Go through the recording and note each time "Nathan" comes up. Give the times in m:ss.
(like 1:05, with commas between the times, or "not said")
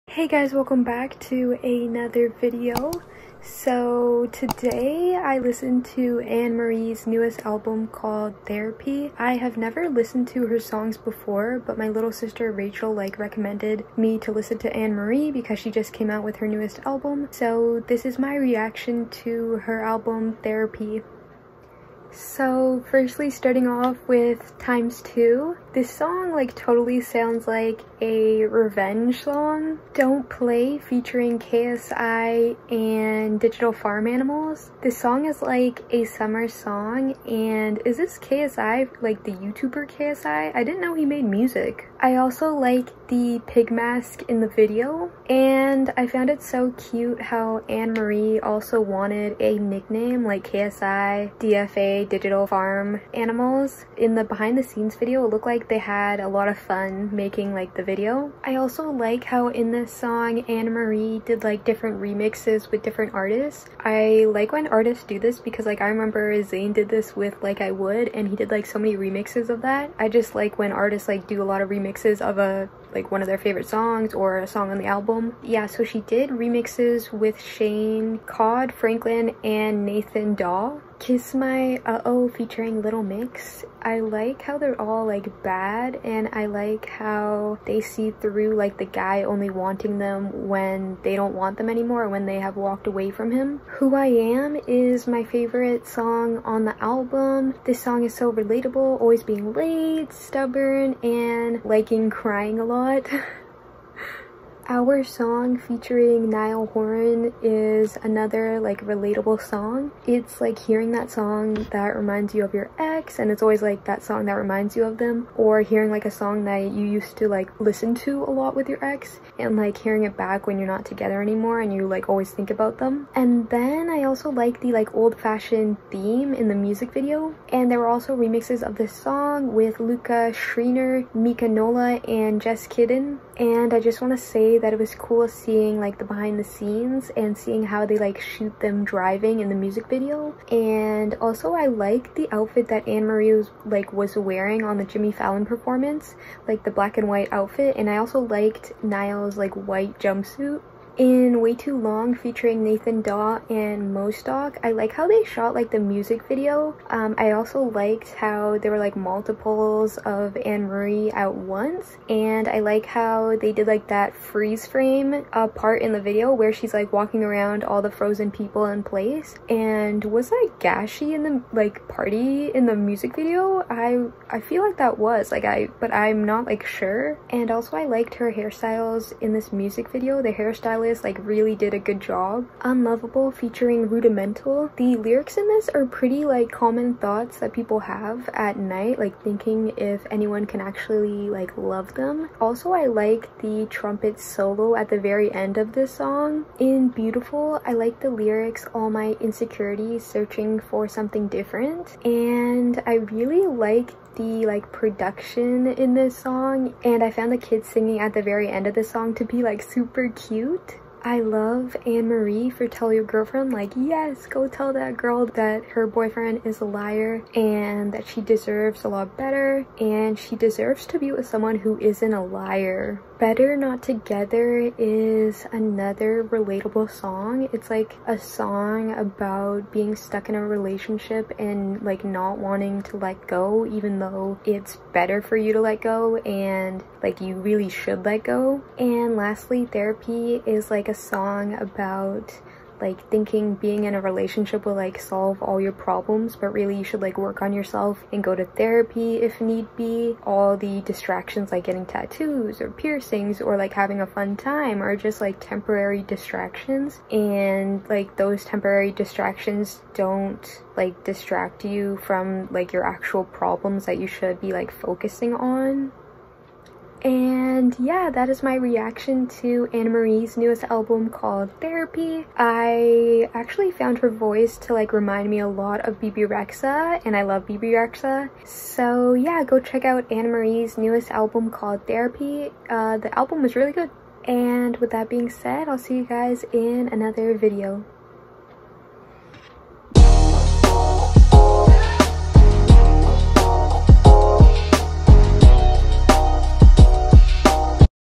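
1:19, 2:32.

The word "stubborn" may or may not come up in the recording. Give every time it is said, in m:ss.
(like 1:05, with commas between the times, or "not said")
1:40.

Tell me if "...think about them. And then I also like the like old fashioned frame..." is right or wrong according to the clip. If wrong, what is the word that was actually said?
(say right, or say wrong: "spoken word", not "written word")
wrong: "theme", not "frame".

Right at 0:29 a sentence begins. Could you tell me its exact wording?
Don't Play featuring KSI and Digital Farm Animals.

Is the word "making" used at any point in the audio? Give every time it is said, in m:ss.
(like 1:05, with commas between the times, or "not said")
0:57.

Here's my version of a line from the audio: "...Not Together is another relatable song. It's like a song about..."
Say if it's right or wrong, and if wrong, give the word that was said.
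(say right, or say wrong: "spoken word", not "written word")
right.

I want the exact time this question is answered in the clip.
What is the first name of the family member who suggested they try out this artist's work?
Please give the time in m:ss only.
0:12.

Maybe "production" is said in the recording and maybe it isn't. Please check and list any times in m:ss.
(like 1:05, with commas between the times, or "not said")
3:24.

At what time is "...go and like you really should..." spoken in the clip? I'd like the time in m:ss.
3:55.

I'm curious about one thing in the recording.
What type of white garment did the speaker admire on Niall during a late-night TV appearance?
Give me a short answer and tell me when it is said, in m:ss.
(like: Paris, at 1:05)
Jumpsuit, at 2:29.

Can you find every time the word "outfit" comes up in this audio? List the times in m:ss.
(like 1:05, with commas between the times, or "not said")
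2:22, 2:27.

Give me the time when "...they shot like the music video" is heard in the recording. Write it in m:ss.
2:35.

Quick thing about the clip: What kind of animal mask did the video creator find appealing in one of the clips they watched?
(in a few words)
Pig.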